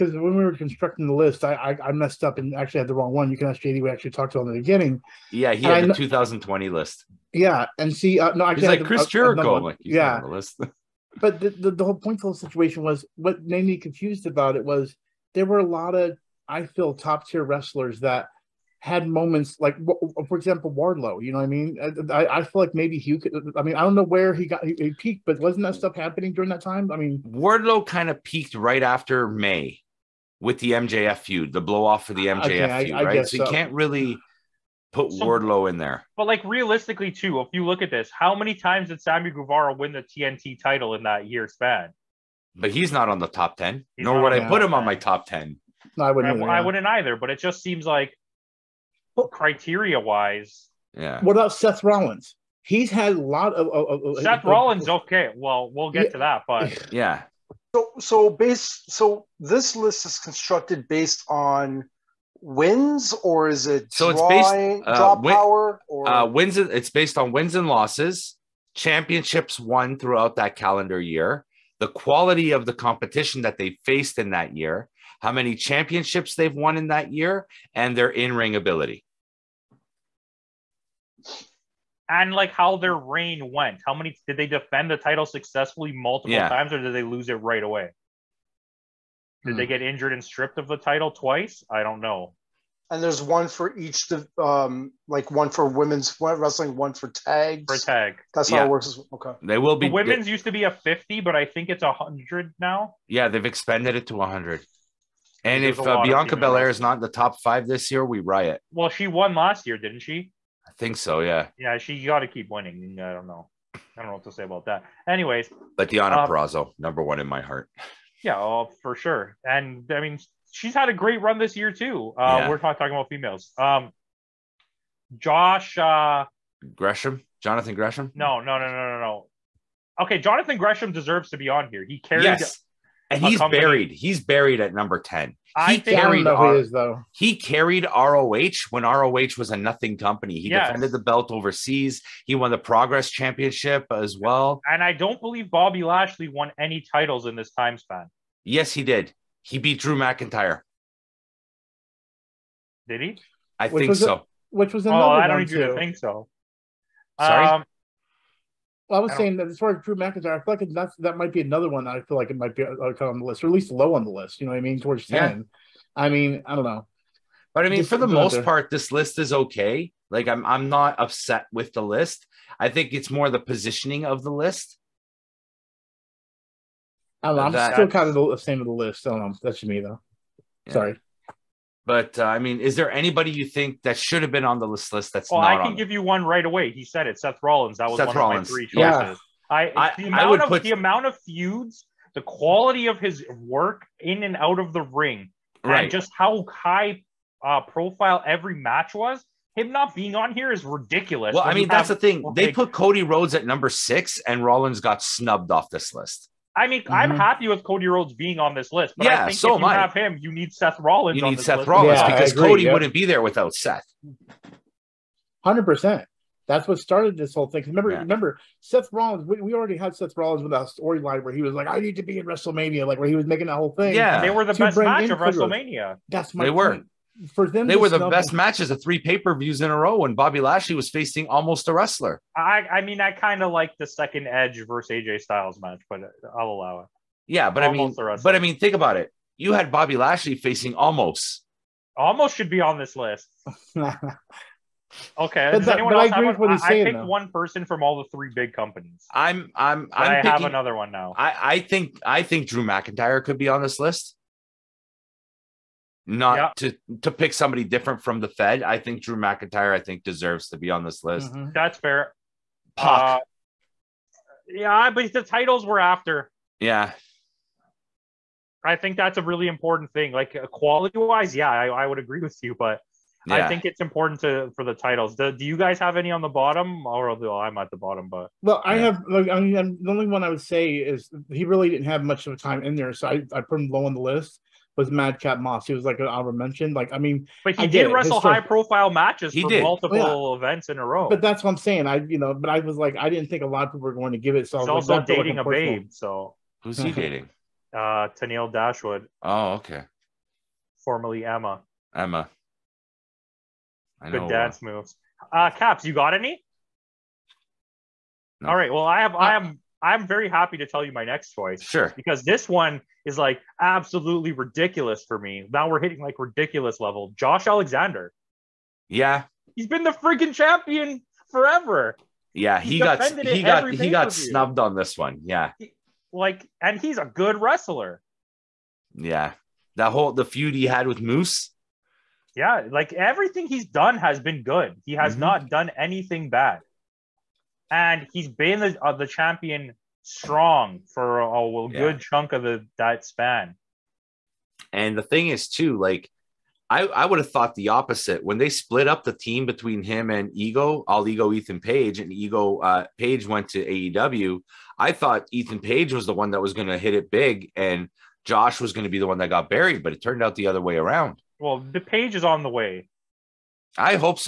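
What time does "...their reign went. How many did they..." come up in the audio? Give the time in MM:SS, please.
01:22.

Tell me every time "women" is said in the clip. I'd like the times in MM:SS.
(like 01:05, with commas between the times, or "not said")
01:35, 01:39.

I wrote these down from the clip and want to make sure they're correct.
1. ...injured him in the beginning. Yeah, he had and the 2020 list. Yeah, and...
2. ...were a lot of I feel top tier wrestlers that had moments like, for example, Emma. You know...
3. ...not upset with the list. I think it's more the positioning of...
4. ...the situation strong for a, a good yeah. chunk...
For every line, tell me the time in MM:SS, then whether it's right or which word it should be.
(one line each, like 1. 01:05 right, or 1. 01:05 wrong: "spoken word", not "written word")
1. 00:04 wrong: "talked", not "injured"
2. 00:15 wrong: "Wardlow", not "Emma"
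3. 02:50 right
4. 05:38 wrong: "champion", not "situation".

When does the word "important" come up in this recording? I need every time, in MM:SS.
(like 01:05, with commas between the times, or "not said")
04:29, 04:33.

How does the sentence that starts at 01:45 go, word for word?
And if uh, Bianca Belair is not in the top five this year, we riot.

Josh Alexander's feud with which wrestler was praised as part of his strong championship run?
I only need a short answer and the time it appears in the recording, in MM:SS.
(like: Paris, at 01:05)
Moose, at 05:30.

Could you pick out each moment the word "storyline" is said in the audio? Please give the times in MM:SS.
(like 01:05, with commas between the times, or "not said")
03:40.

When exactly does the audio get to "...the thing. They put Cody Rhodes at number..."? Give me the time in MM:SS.
03:21.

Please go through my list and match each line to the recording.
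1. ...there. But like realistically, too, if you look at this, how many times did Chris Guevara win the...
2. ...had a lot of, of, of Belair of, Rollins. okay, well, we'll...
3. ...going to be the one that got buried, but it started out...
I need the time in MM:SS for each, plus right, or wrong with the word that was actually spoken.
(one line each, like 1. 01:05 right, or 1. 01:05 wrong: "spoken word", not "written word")
1. 00:35 wrong: "Sammy", not "Chris"
2. 00:52 wrong: "Seth", not "Belair"
3. 05:58 wrong: "turned", not "started".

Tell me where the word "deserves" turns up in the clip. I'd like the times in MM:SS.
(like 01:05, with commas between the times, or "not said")
02:10, 04:20.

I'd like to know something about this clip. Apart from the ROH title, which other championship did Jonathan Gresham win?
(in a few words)
Progress Championship.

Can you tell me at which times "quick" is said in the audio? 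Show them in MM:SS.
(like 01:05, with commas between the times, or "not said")
not said.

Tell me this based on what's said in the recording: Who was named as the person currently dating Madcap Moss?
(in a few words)
Tennille Dashwood.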